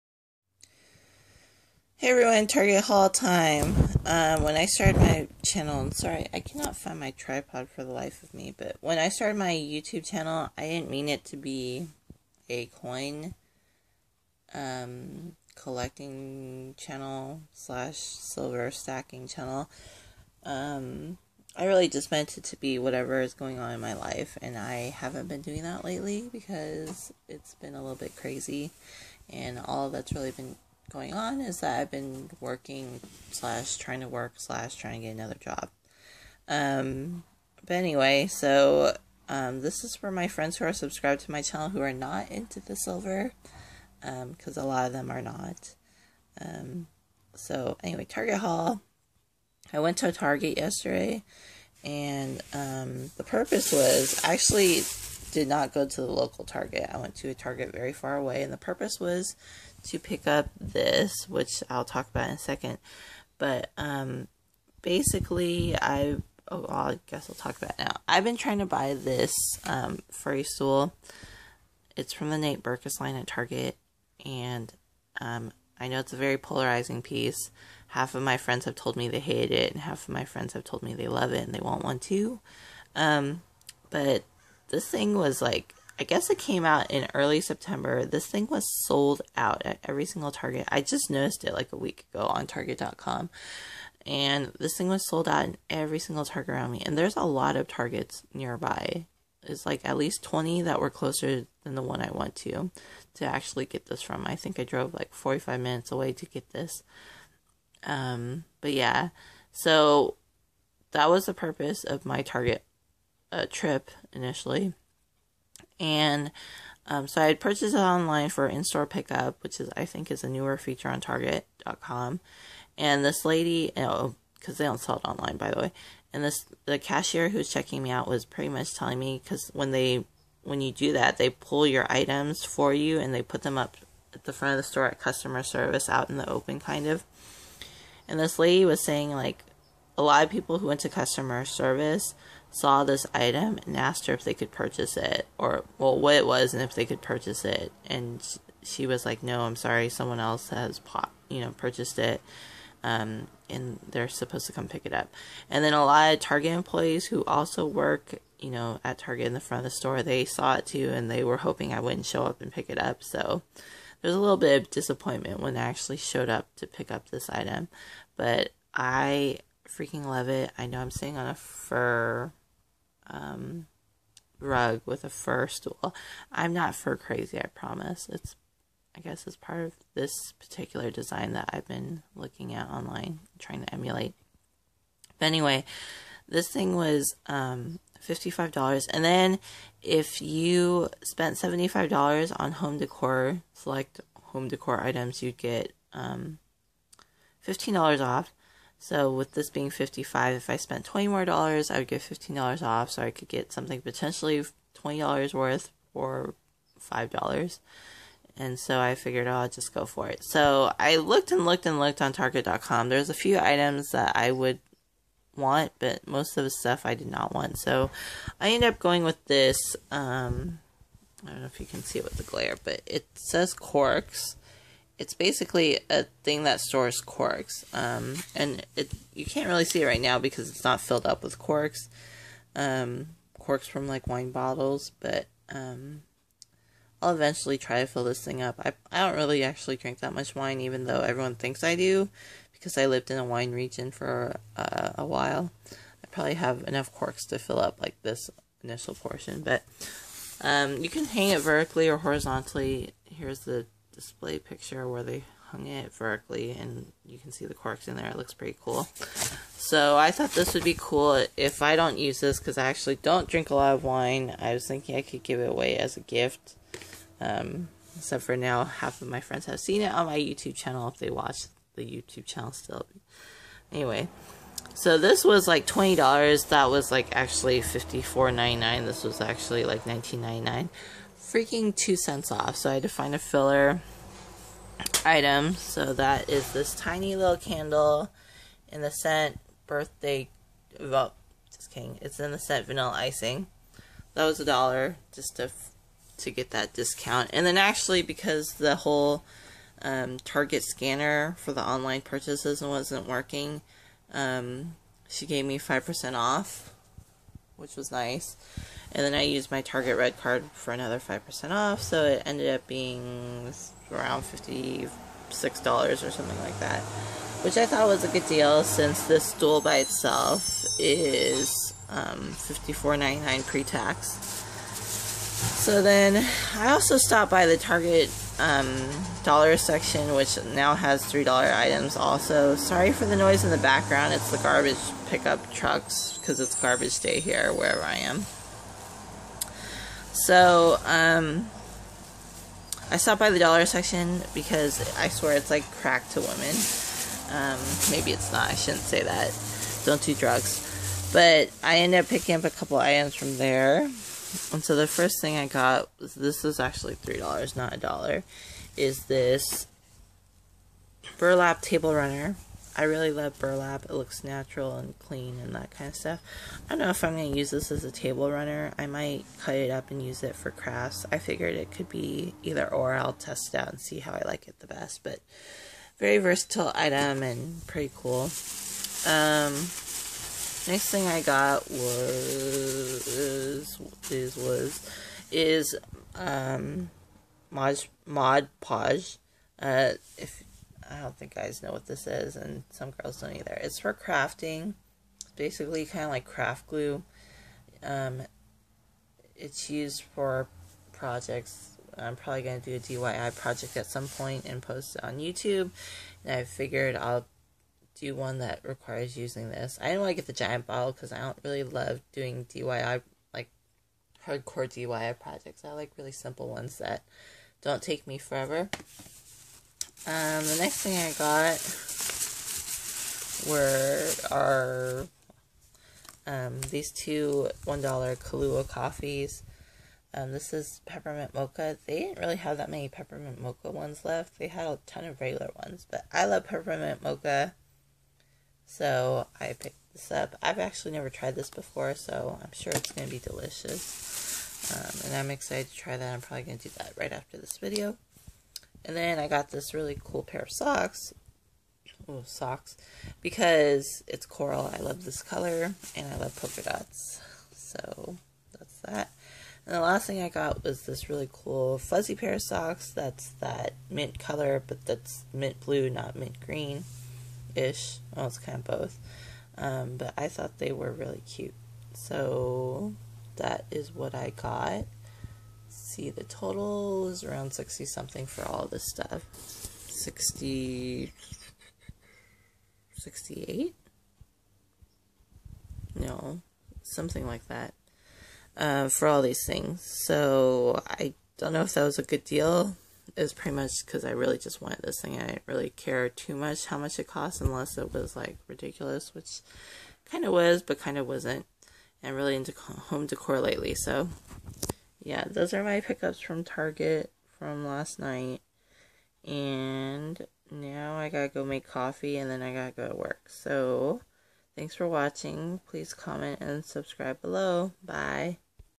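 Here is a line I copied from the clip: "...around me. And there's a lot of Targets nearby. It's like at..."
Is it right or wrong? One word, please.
right.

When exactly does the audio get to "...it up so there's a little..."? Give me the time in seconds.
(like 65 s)
162 s.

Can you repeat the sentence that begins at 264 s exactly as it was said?
I was thinking I could give it away as a gift.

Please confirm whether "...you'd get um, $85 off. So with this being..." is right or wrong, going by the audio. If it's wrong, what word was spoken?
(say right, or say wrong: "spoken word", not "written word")
wrong: "15", not "85".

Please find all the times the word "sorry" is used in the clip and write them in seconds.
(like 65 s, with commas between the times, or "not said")
5 s, 149 s, 332 s.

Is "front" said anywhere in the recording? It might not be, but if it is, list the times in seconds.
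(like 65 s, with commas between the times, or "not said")
134 s, 159 s.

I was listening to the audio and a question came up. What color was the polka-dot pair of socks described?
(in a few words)
coral.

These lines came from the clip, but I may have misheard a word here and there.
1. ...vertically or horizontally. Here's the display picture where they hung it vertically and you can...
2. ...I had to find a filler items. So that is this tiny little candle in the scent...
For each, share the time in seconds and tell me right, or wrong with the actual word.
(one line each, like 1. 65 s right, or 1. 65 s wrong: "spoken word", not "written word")
1. 251 s right
2. 282 s right.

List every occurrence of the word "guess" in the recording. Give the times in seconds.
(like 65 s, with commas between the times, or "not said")
67 s, 86 s, 179 s.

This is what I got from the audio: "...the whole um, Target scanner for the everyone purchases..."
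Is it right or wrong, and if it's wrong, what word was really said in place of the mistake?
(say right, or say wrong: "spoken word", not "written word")
wrong: "online", not "everyone".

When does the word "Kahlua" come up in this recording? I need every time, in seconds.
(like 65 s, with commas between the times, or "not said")
427 s.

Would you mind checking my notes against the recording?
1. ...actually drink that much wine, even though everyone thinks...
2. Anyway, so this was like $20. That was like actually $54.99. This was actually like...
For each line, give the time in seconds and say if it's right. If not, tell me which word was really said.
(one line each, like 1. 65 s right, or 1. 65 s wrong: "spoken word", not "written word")
1. 239 s right
2. 273 s right.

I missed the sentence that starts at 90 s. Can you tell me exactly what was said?
I just noticed it like a week ago on Target.com.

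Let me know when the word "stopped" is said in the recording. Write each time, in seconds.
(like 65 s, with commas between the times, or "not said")
326 s, 342 s.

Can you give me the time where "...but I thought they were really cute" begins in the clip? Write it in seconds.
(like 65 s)
469 s.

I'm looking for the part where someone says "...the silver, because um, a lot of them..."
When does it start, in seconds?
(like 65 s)
42 s.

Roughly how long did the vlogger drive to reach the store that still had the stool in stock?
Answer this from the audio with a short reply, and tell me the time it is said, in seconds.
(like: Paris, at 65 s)
45 minutes, at 105 s.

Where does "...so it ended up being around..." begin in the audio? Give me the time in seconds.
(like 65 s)
311 s.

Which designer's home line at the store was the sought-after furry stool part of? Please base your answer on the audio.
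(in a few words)
Nate Berkus.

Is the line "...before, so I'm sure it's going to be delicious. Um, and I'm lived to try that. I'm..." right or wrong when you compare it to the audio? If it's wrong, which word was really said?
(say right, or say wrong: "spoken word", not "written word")
wrong: "excited", not "lived".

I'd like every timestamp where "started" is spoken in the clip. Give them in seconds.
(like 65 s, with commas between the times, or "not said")
4 s, 9 s.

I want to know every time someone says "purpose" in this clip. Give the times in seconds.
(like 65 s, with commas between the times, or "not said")
53 s, 58 s, 111 s.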